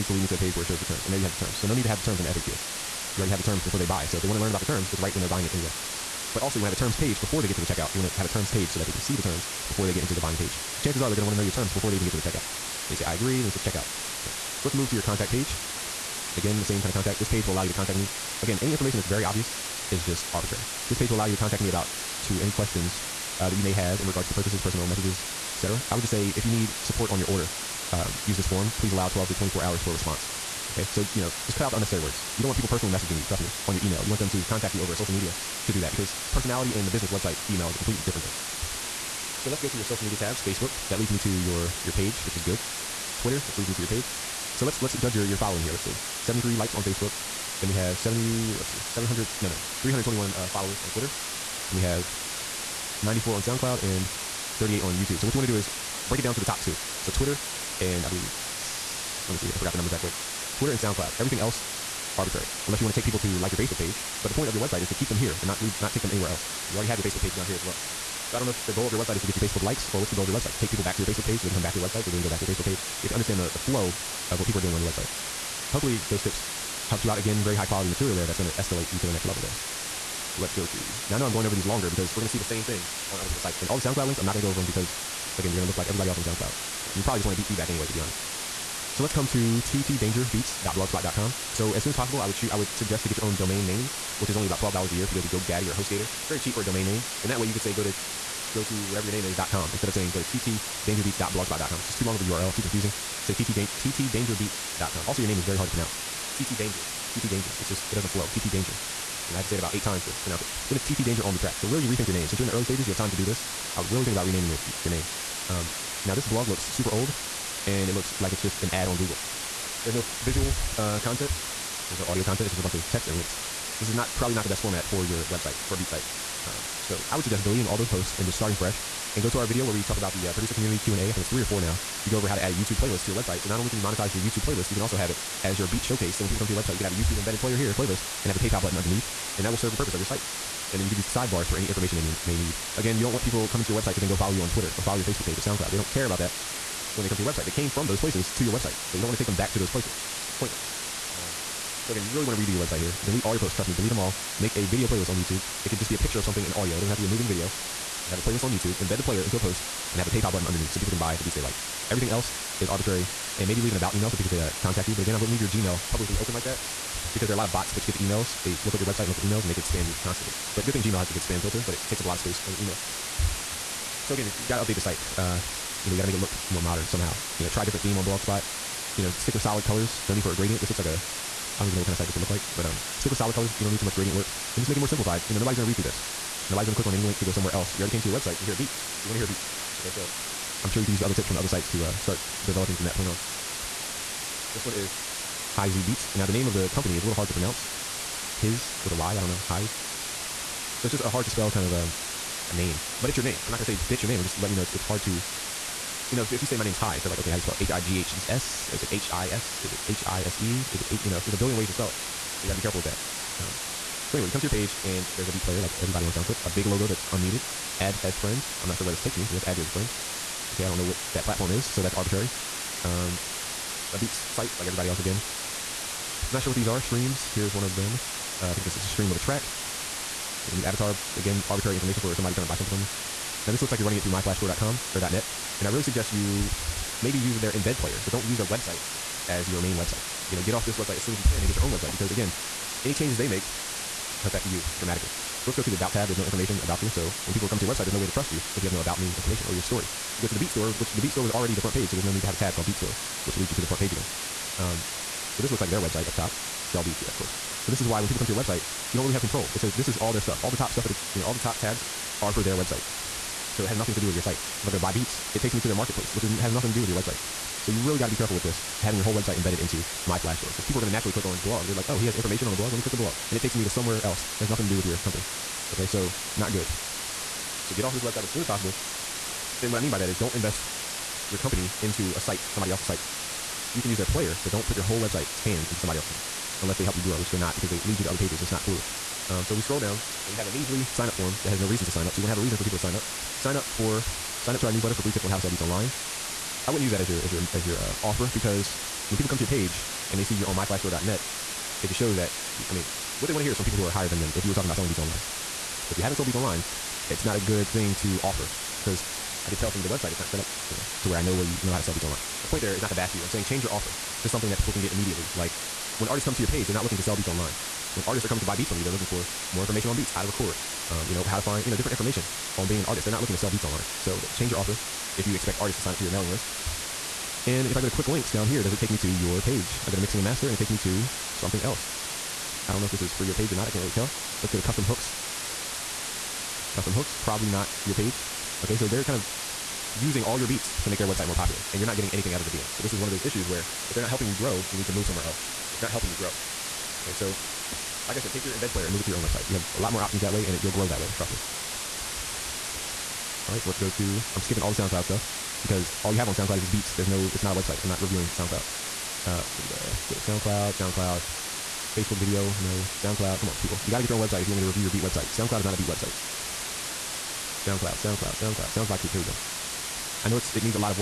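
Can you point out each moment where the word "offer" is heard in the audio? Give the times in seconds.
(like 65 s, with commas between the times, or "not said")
298 s, 308 s, 313 s, 324 s.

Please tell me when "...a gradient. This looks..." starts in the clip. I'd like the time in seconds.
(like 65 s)
180 s.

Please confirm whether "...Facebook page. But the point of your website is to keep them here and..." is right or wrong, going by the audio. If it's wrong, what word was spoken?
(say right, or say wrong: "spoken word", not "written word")
right.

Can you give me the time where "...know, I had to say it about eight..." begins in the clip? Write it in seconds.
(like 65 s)
109 s.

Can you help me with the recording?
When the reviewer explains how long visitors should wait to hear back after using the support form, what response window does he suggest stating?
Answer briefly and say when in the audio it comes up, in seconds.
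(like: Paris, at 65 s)
12 to 24 hours, at 29 s.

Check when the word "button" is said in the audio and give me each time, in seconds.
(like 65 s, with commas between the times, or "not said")
138 s, 160 s.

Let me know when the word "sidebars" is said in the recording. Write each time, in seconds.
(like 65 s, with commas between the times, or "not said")
141 s.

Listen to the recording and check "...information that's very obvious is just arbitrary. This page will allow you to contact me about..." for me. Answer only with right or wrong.
right.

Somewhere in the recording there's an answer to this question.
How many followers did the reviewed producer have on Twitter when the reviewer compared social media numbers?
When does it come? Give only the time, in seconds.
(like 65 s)
49 s.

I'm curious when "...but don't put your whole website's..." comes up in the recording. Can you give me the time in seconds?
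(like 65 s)
284 s.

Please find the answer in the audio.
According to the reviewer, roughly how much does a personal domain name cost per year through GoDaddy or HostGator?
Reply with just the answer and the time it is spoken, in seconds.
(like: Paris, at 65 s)
$12, at 94 s.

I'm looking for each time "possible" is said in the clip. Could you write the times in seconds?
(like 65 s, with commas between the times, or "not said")
91 s, 278 s.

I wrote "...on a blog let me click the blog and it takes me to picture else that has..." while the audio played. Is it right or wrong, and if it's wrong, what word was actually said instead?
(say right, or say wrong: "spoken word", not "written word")
wrong: "somewhere", not "picture".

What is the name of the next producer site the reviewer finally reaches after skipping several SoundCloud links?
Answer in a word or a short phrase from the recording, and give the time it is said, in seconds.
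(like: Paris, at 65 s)
Sounds by Coop, at 368 s.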